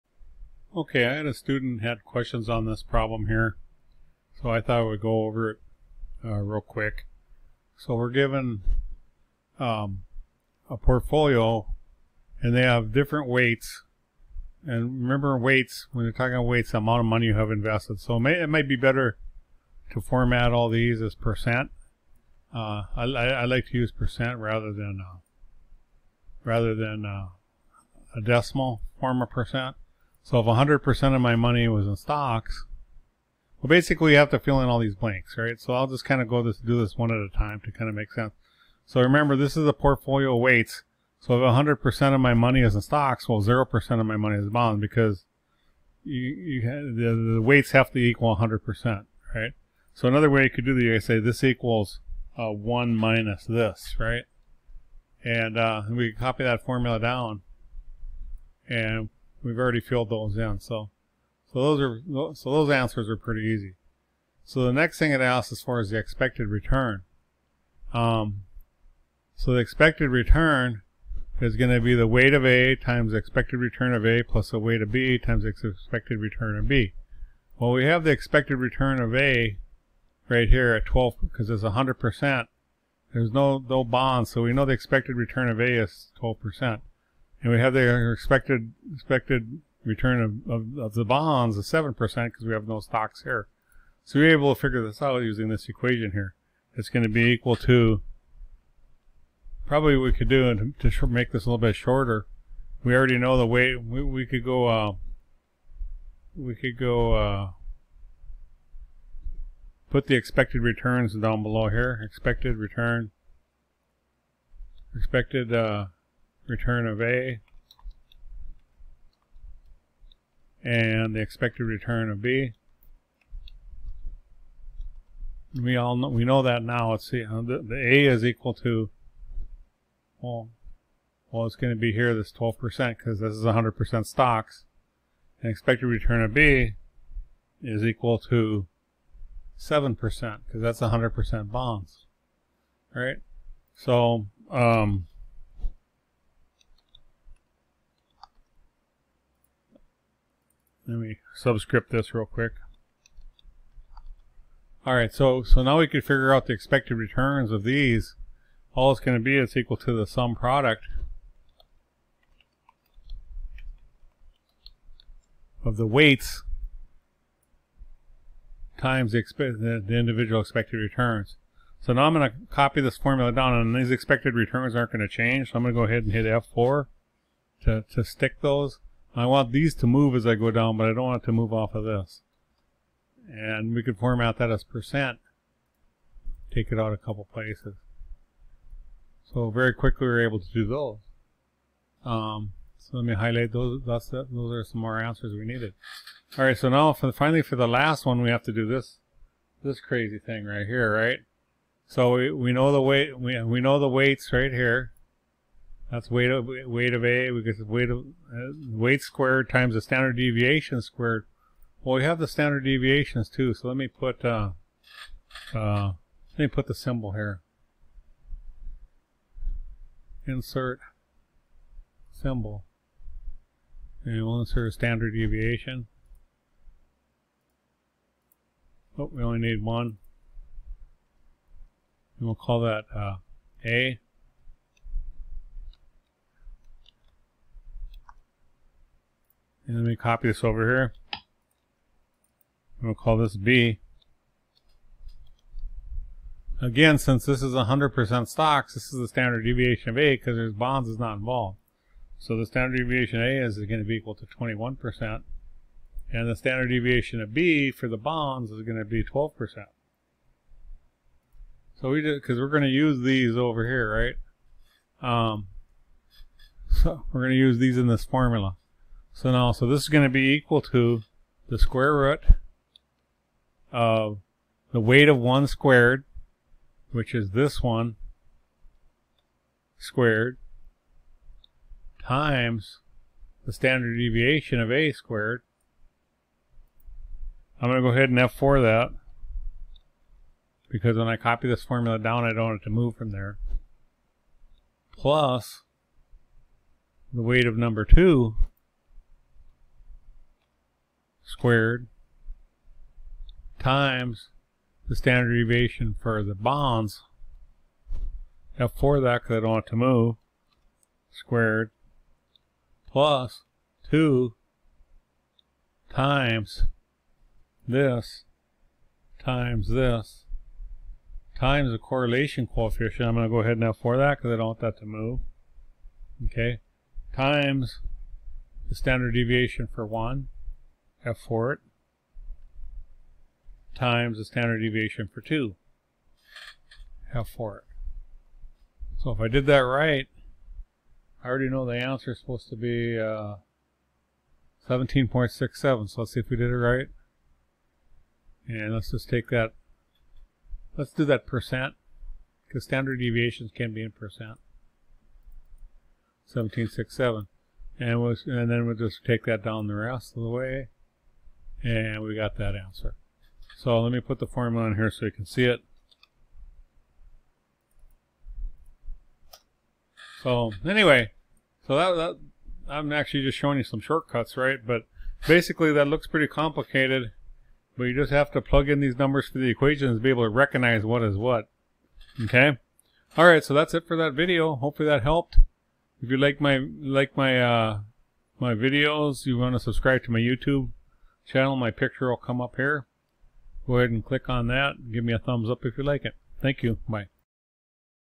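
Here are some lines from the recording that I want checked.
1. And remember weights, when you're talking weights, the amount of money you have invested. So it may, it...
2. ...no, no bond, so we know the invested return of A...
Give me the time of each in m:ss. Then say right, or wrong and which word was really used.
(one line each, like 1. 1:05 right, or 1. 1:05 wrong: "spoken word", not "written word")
1. 0:14 right
2. 1:23 wrong: "expected", not "invested".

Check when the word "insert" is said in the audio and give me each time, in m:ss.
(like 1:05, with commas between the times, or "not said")
3:40, 3:44.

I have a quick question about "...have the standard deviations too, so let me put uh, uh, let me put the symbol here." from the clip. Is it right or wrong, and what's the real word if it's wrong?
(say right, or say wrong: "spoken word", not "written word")
right.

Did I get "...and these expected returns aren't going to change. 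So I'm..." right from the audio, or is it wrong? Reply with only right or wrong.
right.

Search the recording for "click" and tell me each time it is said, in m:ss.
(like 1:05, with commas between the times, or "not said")
6:34.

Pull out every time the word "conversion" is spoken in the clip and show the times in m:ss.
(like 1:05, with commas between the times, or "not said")
not said.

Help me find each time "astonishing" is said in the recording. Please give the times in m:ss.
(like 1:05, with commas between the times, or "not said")
not said.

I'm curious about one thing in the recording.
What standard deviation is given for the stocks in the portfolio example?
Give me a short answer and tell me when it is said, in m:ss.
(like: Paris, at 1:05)
21%, at 4:14.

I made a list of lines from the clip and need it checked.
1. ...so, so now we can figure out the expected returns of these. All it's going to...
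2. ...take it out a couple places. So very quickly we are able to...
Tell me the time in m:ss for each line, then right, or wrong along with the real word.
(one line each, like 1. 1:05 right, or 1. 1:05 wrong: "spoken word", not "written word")
1. 2:35 right
2. 3:06 right.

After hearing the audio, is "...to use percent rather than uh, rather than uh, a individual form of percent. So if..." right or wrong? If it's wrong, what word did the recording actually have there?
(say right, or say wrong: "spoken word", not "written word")
wrong: "decimal", not "individual".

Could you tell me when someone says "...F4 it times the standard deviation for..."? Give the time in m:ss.
5:31.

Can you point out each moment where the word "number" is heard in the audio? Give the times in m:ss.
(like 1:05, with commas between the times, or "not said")
4:57, 6:18.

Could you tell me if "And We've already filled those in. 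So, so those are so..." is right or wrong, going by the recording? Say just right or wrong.
right.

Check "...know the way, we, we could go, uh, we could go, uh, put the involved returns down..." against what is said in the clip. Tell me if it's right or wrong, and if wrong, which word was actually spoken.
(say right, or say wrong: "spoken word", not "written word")
wrong: "expected", not "involved".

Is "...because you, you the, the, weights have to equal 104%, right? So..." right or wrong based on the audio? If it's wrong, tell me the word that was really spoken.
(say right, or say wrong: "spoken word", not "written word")
wrong: "100", not "104".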